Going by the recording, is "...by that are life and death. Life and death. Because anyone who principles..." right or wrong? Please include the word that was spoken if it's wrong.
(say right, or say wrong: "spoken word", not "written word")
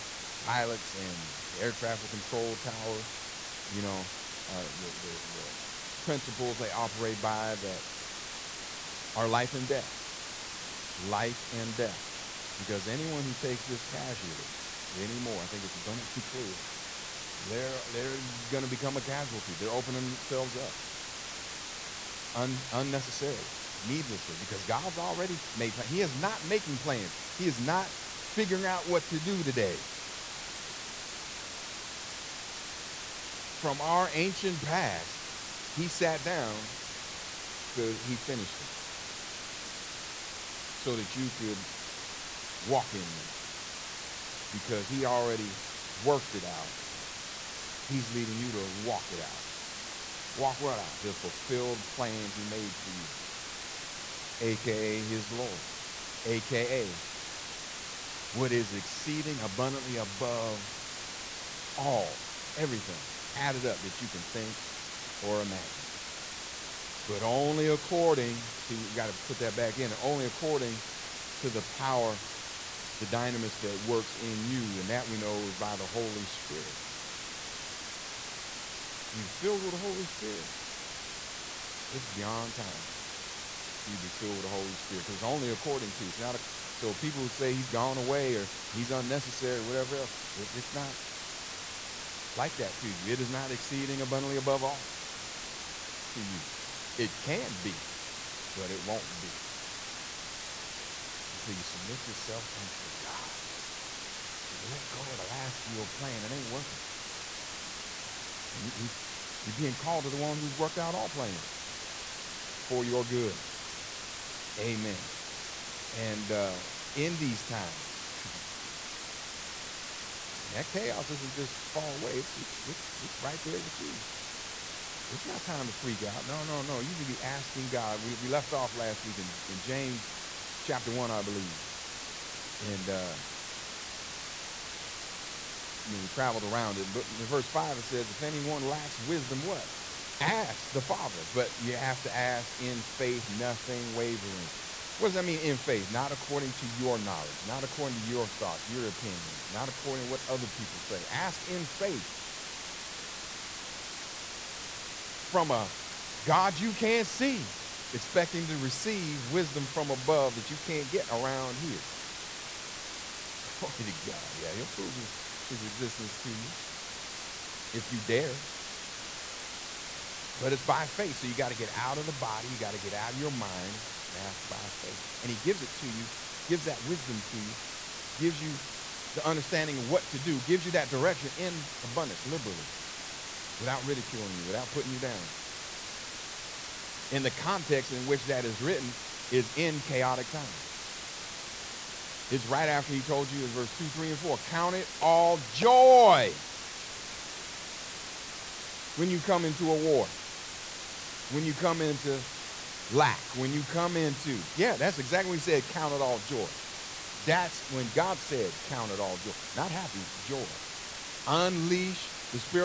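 wrong: "takes", not "principles".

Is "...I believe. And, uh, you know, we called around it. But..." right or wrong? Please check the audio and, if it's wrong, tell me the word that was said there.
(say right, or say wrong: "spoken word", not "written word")
wrong: "traveled", not "called".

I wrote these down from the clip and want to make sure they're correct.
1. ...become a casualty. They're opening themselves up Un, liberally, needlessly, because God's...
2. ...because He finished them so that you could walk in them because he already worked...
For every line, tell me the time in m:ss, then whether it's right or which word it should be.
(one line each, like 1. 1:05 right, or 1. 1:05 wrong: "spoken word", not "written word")
1. 0:18 wrong: "unnecessarily", not "liberally"
2. 0:37 right.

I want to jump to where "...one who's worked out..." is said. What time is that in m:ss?
1:50.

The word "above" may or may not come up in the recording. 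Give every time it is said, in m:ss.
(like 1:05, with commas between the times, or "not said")
0:59, 1:34, 2:39.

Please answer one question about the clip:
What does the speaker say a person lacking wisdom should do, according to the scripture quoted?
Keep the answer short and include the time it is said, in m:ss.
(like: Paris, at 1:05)
Ask the Father, at 2:20.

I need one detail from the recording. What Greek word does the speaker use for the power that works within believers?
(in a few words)
dynamis.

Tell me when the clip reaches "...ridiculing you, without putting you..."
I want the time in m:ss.
3:03.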